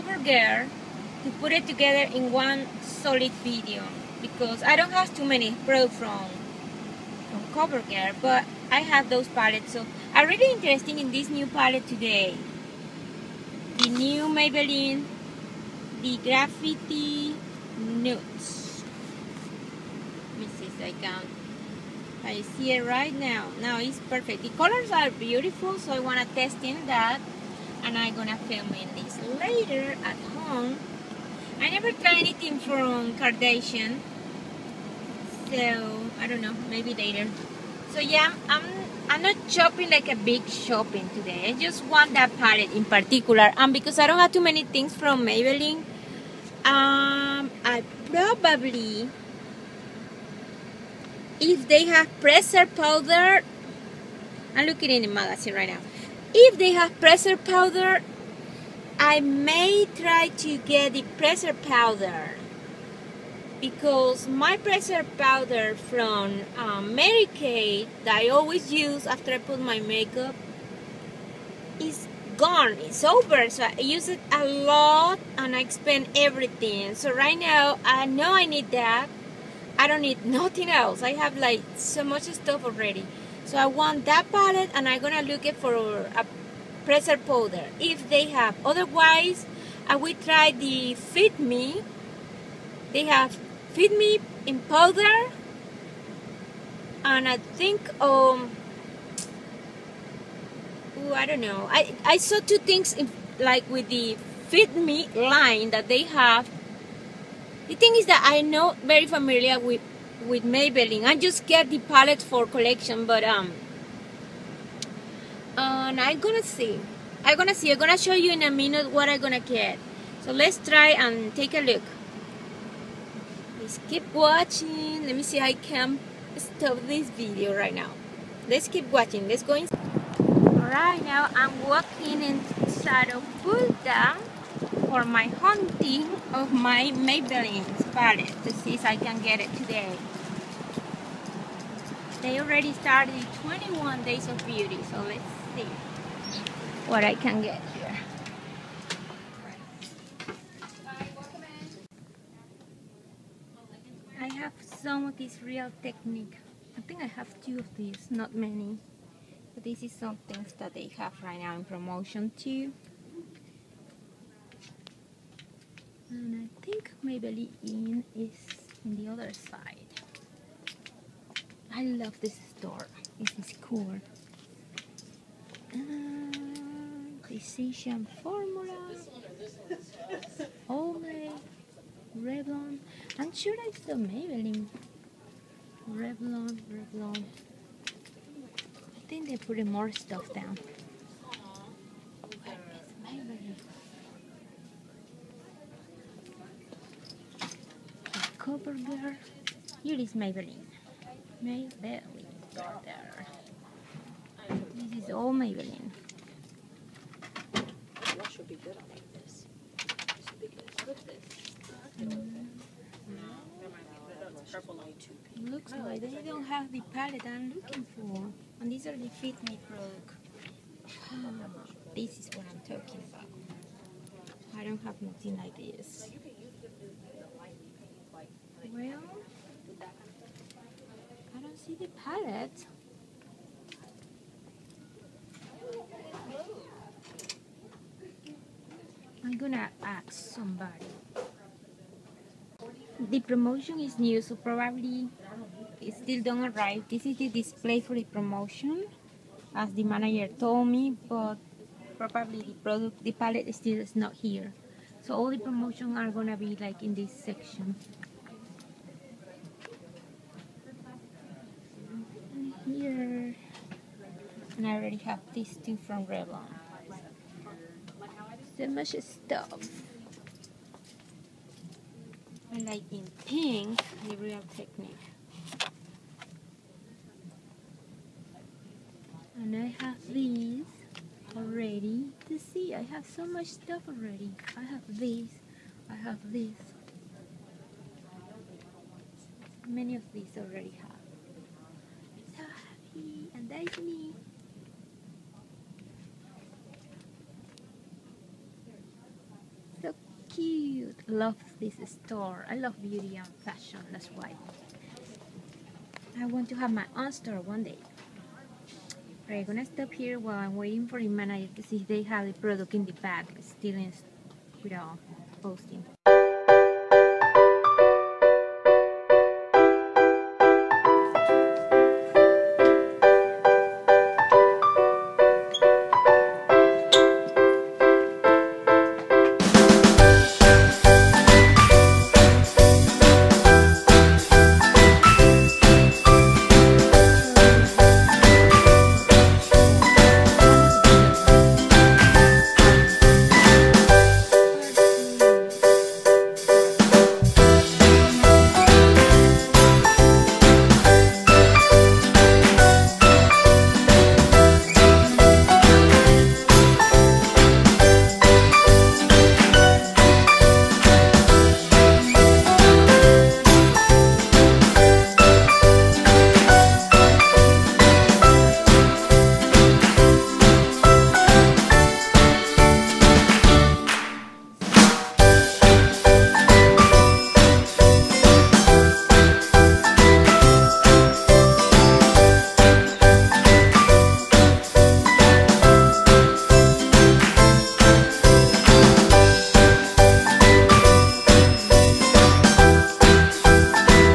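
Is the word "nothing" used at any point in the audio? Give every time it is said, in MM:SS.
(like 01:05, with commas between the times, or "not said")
01:20, 03:45.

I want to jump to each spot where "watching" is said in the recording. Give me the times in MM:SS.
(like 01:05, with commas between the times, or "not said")
02:04, 02:08.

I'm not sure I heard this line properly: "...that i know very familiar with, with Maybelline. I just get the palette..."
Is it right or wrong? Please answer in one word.
right.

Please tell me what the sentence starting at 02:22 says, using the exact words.
They already started 21 days of beauty, so let's see what I can get here.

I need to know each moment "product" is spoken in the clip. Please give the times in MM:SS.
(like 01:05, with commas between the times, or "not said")
03:39, 04:12, 05:12.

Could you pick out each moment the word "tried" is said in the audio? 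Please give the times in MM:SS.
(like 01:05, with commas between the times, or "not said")
00:31.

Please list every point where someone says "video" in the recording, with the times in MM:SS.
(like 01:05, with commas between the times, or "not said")
00:03, 02:07.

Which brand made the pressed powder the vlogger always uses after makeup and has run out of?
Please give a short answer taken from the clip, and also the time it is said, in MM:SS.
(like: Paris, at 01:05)
Mary Kay, at 01:06.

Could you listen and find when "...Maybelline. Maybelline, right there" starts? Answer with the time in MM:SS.
03:20.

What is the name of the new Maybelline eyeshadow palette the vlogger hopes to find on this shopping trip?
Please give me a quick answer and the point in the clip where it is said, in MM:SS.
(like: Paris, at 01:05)
Graffiti Nudes, at 00:16.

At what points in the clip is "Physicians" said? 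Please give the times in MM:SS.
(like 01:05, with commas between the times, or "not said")
02:57.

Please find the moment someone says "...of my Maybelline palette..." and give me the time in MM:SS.
02:16.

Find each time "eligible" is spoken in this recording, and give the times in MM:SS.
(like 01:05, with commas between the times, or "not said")
not said.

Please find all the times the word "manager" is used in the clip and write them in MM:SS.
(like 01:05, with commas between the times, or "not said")
04:09, 05:11.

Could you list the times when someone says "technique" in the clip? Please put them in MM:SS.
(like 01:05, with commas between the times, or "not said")
02:35, 04:34.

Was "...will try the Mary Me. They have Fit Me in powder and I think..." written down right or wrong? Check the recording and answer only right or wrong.
wrong.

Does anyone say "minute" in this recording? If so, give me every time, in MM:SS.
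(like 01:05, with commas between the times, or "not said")
01:58.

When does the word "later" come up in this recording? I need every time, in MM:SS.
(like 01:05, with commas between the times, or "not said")
00:29, 00:36.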